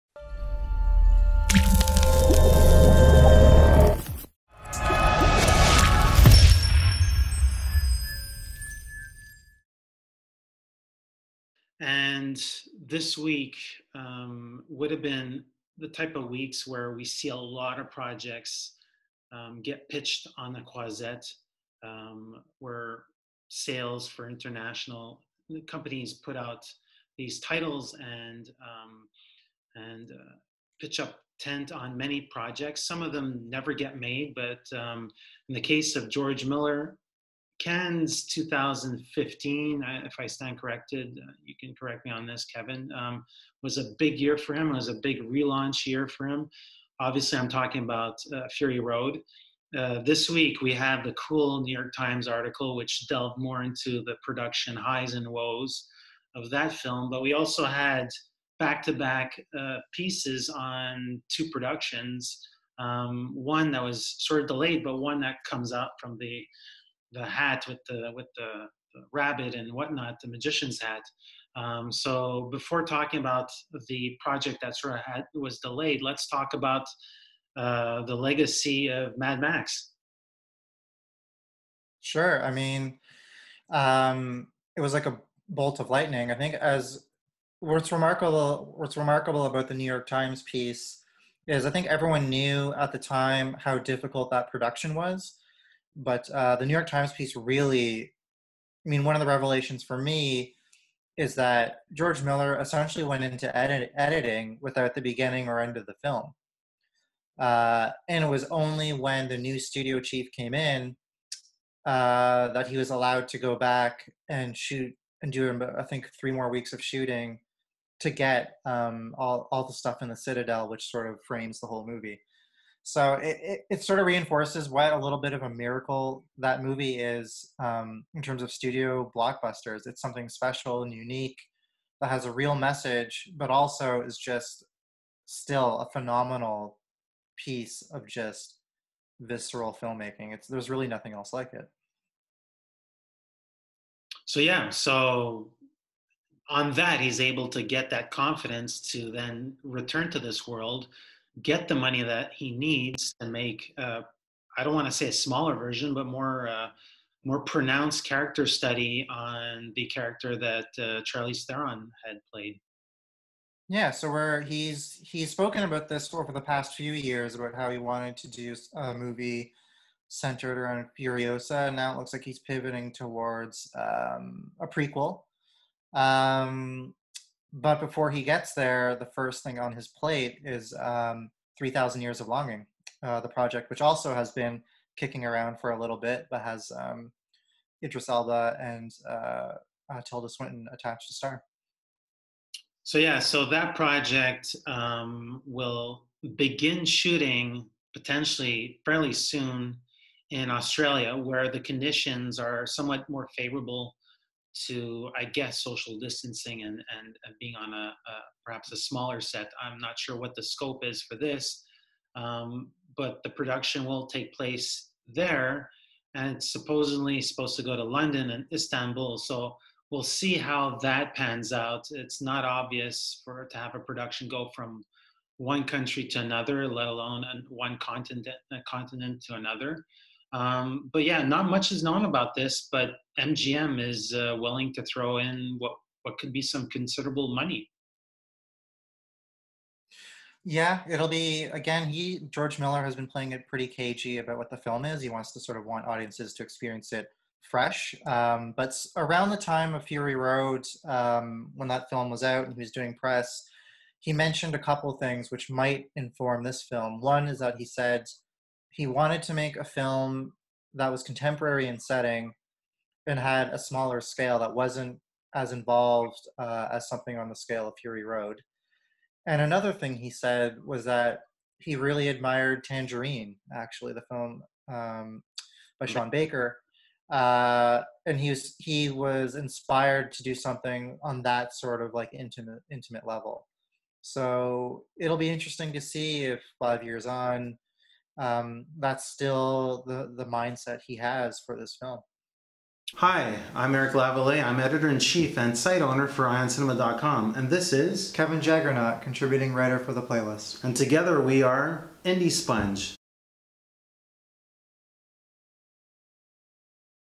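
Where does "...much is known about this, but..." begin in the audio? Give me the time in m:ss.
3:51.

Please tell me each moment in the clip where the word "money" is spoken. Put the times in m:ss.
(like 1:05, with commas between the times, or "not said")
2:31, 3:57.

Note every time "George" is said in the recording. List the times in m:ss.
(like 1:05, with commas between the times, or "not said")
0:36, 1:41, 4:02.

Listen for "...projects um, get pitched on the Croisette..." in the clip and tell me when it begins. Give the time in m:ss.
0:17.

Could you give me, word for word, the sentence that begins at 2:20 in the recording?
It's there's really nothing else like it.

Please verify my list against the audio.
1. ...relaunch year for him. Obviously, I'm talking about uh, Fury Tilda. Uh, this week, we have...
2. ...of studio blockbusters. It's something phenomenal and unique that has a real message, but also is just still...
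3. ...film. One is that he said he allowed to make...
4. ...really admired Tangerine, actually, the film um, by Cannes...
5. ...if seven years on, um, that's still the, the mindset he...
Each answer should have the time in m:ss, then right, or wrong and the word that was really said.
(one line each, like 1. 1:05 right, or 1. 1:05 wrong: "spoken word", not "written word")
1. 0:45 wrong: "Road", not "Tilda"
2. 2:08 wrong: "special", not "phenomenal"
3. 4:16 wrong: "wanted", not "allowed"
4. 4:31 wrong: "Sean", not "Cannes"
5. 4:46 wrong: "five", not "seven".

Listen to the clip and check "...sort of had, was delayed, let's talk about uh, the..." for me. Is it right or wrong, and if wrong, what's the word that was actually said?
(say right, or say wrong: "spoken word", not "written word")
right.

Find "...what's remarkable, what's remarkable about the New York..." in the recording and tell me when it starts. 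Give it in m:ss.
1:27.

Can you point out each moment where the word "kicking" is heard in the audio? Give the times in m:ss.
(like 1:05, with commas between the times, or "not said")
3:04.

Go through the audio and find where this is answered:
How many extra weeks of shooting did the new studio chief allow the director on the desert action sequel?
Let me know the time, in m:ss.
1:56.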